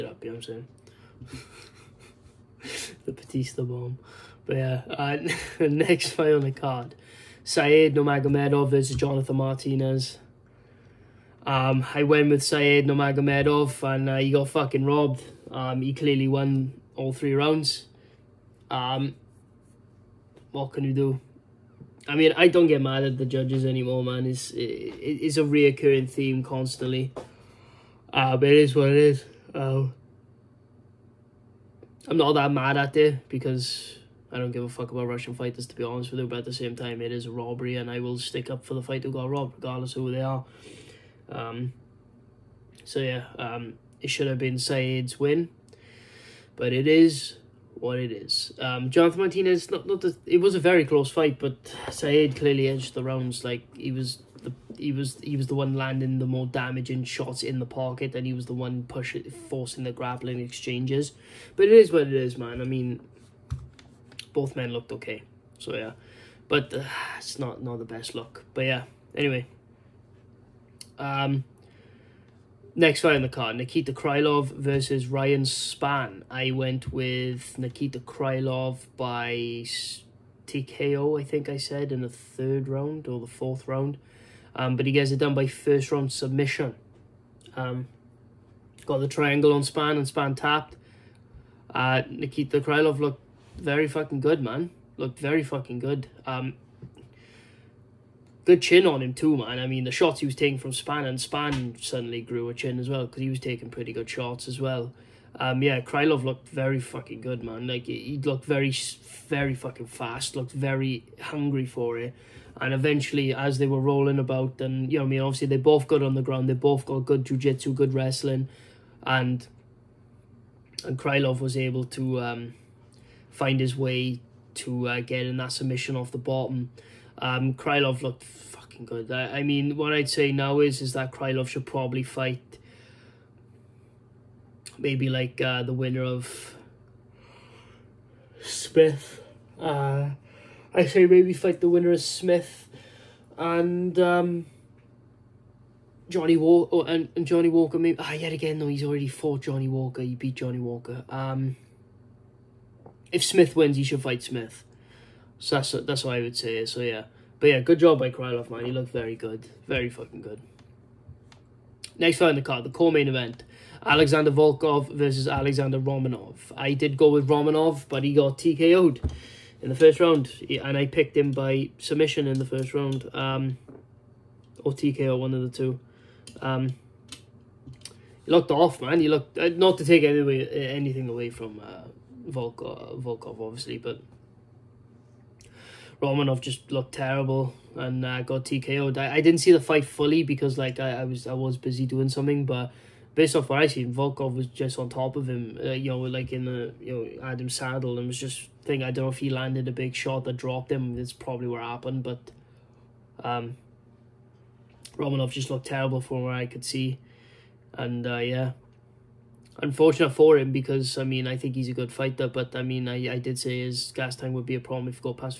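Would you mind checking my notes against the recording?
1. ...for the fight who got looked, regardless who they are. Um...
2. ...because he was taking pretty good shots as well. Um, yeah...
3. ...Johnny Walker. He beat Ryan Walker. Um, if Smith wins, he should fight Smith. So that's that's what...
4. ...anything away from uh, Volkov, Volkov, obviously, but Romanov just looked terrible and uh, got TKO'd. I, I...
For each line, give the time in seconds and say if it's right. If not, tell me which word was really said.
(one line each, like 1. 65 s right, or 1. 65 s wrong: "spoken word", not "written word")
1. 38 s wrong: "robbed", not "looked"
2. 103 s right
3. 149 s wrong: "Johnny", not "Ryan"
4. 180 s right.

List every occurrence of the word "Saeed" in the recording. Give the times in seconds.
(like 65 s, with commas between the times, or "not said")
7 s, 12 s, 44 s, 51 s.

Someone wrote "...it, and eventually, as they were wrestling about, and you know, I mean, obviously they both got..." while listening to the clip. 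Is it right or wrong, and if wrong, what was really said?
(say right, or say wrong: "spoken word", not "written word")
wrong: "rolling", not "wrestling".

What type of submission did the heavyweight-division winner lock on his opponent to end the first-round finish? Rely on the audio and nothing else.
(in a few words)
Triangle.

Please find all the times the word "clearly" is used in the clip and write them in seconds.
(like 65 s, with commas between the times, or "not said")
15 s, 52 s.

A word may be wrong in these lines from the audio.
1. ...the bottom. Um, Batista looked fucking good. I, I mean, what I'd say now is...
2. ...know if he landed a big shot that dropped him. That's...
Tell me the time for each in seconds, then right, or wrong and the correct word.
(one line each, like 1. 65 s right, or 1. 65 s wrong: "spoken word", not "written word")
1. 126 s wrong: "Krylov", not "Batista"
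2. 199 s right.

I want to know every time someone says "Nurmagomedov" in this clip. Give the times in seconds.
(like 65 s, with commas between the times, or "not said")
7 s, 12 s.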